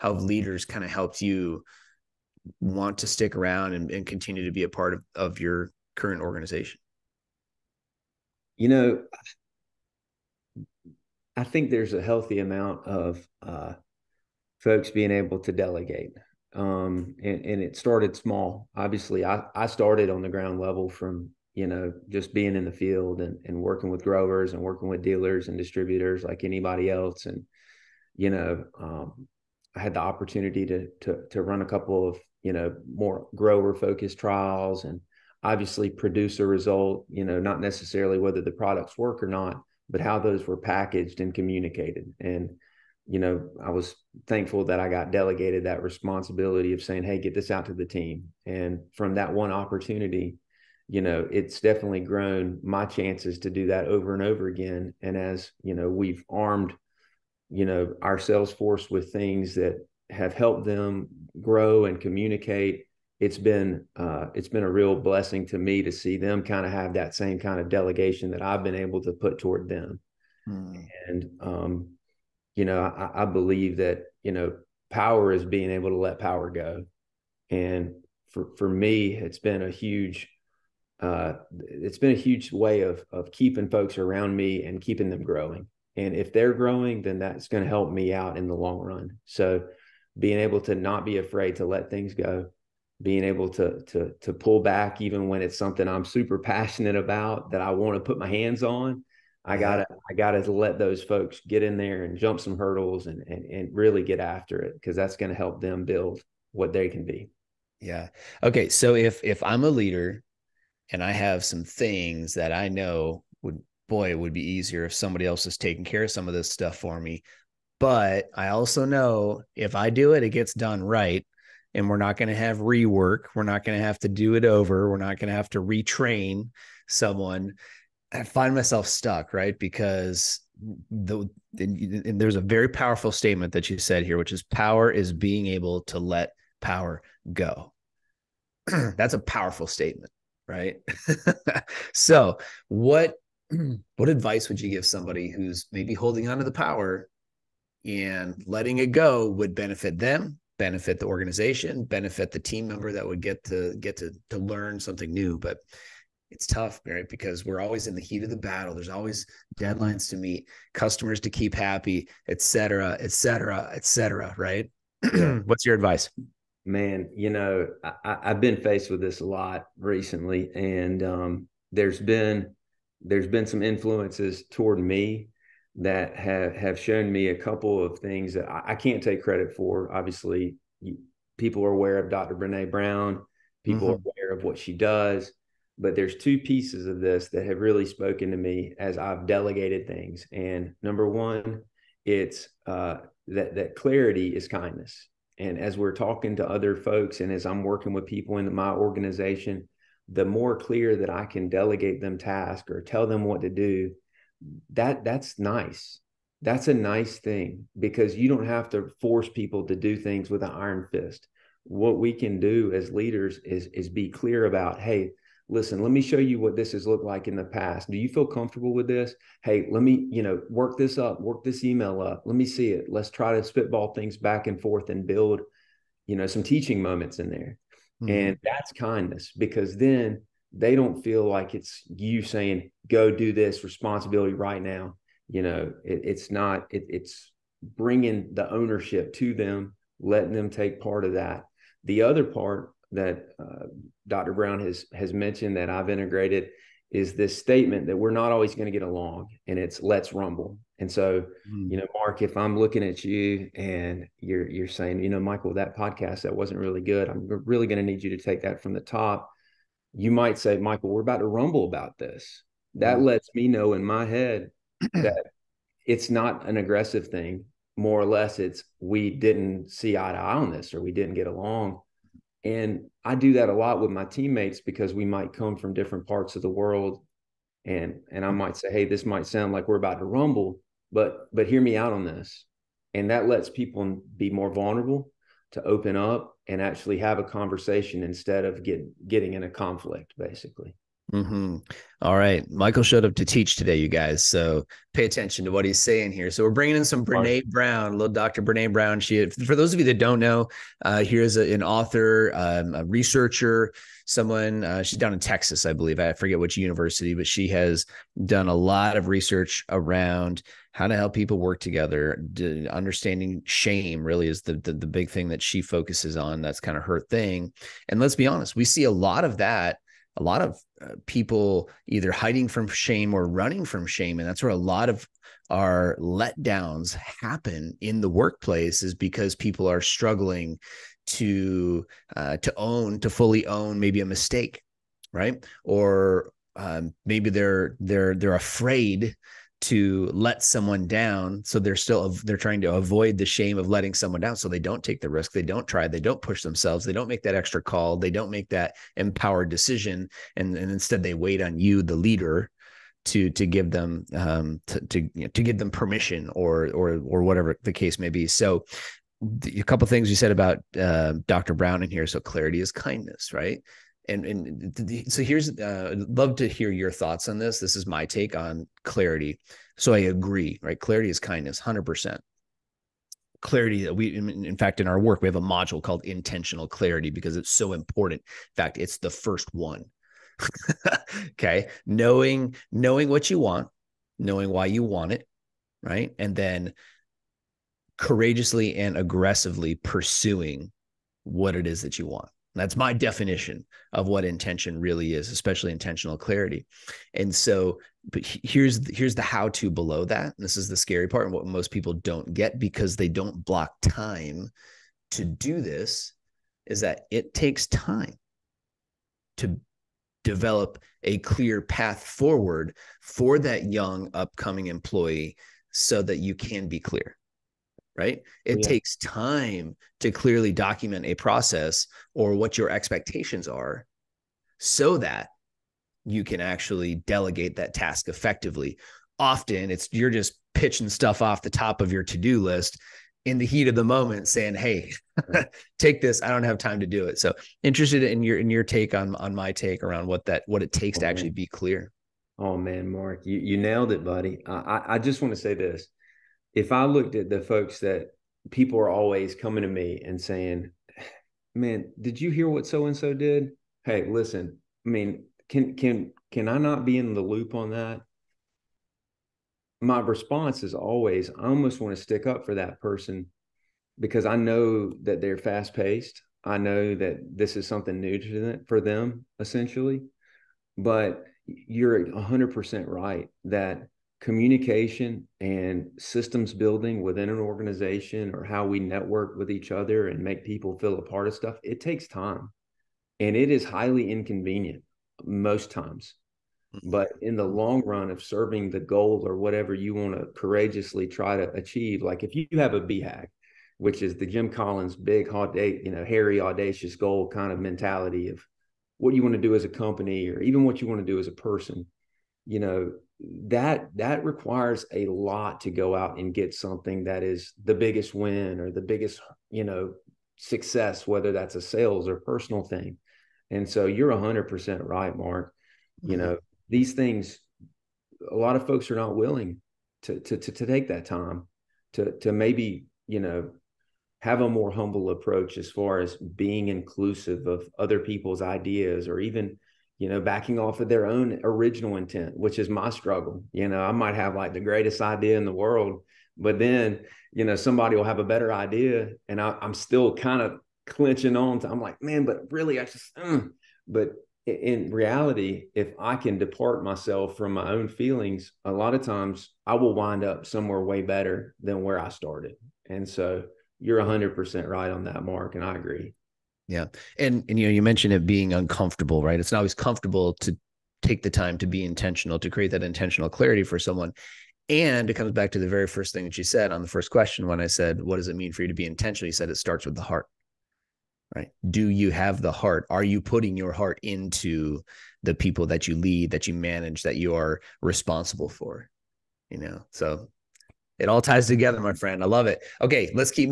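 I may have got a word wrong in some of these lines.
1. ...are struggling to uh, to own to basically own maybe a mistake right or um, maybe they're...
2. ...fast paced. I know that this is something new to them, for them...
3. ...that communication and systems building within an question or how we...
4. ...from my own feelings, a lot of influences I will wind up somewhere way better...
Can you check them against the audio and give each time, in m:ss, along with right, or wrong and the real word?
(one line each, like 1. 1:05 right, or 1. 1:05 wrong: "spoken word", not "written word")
1. 5:29 wrong: "fully", not "basically"
2. 7:45 right
3. 7:53 wrong: "organization", not "question"
4. 9:07 wrong: "times", not "influences".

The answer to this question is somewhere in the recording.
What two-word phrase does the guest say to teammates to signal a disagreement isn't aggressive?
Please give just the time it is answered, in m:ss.
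4:09.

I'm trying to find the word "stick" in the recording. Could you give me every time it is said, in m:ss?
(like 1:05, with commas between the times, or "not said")
0:03, 7:42.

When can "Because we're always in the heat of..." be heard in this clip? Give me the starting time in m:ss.
2:37.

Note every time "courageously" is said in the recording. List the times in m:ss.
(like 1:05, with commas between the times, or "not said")
6:27, 8:10.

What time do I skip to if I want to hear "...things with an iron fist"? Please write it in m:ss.
3:29.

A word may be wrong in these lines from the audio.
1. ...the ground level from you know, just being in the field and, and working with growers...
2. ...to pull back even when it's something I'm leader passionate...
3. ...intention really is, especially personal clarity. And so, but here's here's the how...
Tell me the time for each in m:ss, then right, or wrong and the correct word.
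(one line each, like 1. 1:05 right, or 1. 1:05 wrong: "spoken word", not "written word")
1. 0:20 right
2. 1:34 wrong: "super", not "leader"
3. 6:34 wrong: "intentional", not "personal".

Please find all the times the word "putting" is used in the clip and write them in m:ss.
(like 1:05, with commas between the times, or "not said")
9:33.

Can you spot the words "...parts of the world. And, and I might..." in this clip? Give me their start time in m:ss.
4:36.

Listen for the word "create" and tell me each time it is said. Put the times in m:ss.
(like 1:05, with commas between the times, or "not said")
9:22.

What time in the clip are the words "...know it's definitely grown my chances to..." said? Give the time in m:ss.
0:51.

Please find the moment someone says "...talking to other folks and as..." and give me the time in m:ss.
3:15.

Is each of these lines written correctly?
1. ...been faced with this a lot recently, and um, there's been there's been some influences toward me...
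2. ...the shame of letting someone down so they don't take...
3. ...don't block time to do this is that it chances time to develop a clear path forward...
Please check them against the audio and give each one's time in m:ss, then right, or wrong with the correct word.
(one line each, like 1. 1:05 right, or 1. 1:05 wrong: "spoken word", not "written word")
1. 2:48 right
2. 5:43 right
3. 6:43 wrong: "takes", not "chances".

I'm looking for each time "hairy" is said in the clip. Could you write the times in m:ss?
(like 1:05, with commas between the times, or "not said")
8:16.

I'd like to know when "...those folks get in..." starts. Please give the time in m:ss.
1:40.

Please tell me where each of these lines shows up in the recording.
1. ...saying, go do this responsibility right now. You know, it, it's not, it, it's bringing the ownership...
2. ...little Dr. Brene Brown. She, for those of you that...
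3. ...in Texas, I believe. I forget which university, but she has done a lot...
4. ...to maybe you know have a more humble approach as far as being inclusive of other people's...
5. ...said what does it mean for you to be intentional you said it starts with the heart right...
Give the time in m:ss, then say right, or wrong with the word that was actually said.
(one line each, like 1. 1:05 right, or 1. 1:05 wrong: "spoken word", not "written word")
1. 3:52 right
2. 4:57 right
3. 5:05 right
4. 8:42 right
5. 9:27 right.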